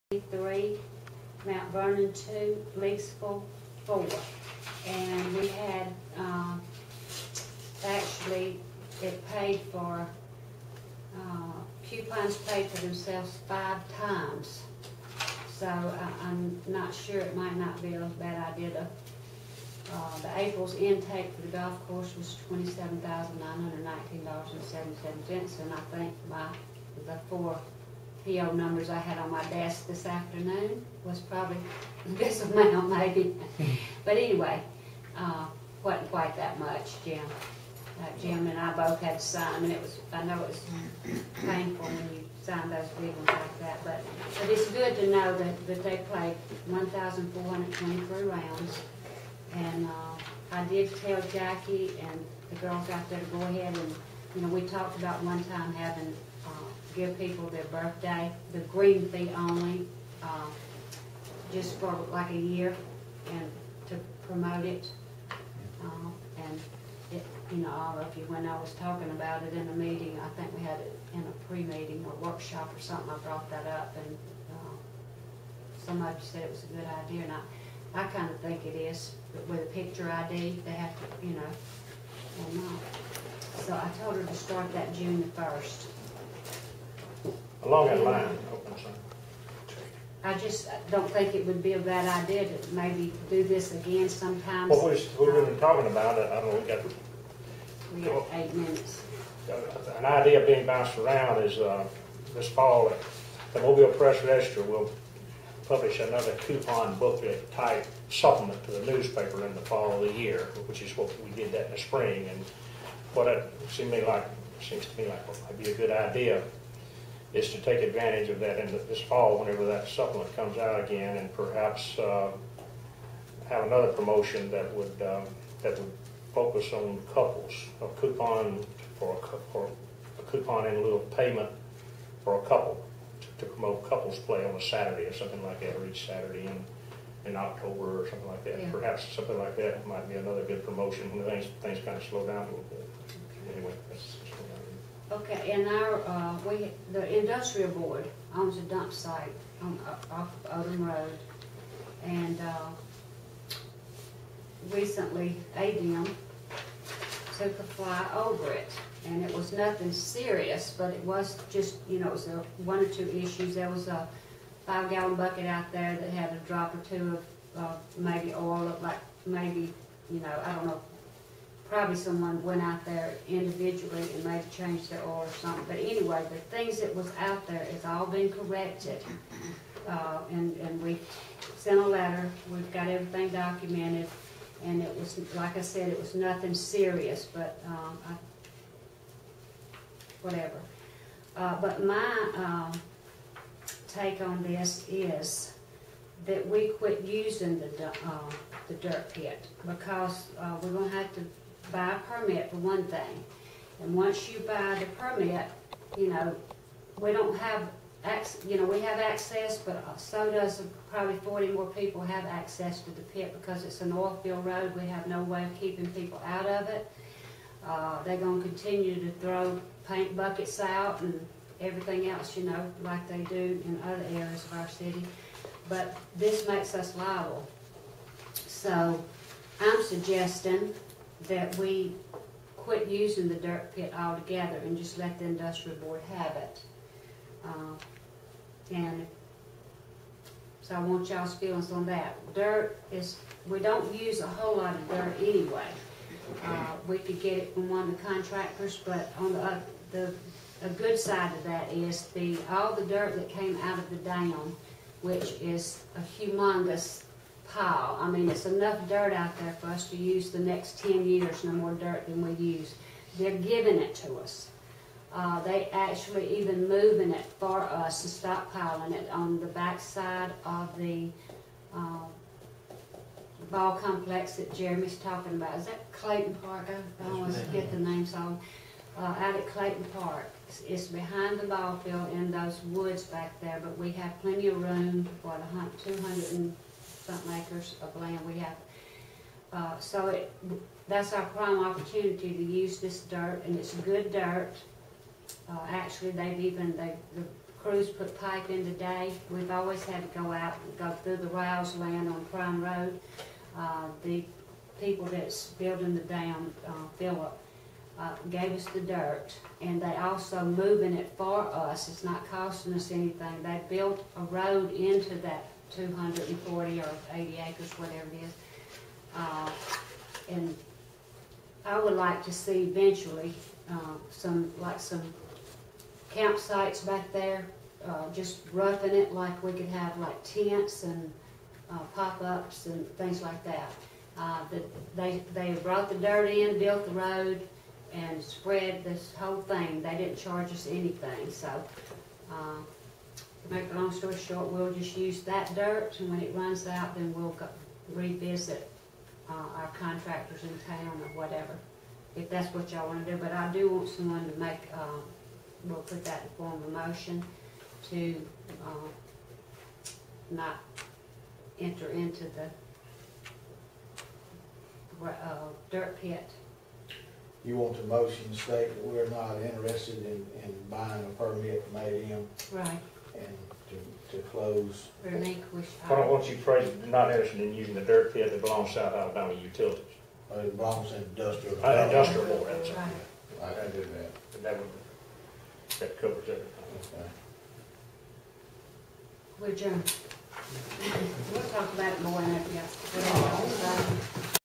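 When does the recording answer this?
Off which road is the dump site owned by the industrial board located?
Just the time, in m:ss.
2:30.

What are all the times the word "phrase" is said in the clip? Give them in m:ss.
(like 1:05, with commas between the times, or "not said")
6:16.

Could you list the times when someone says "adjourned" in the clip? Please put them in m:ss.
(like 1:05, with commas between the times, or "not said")
6:29.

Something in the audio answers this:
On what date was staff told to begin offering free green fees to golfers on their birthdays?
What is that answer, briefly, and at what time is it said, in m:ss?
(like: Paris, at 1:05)
June 1, at 1:24.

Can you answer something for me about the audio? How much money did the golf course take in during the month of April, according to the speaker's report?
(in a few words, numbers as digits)
$27,919.77.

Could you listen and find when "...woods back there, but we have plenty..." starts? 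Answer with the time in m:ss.
4:42.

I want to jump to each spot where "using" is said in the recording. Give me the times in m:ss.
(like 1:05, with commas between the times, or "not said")
3:17, 3:52, 6:17.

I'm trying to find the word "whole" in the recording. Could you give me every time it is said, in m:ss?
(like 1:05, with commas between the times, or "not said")
4:04, 5:39.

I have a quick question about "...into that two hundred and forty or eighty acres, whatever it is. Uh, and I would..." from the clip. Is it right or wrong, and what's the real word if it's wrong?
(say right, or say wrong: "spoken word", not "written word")
right.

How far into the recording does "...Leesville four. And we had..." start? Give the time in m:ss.
0:02.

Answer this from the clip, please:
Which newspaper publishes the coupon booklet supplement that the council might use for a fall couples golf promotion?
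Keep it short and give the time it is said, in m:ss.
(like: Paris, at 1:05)
Mobile Press Register, at 1:43.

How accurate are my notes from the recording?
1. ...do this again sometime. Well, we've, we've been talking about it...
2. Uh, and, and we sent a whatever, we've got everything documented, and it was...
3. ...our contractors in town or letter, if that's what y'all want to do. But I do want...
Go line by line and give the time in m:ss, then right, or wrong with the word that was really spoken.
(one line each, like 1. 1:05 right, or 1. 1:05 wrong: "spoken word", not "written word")
1. 1:33 right
2. 2:59 wrong: "letter", not "whatever"
3. 5:49 wrong: "whatever", not "letter".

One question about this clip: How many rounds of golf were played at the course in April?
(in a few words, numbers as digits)
1,423.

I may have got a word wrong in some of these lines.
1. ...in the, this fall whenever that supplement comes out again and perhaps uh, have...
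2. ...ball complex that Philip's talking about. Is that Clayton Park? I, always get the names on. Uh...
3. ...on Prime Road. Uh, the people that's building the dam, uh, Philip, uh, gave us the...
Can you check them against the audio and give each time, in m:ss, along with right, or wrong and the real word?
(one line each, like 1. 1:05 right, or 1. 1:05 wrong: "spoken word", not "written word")
1. 1:58 right
2. 4:33 wrong: "Jeremy", not "Philip"
3. 5:02 right.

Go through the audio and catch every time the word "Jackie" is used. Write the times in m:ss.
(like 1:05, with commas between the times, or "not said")
0:51.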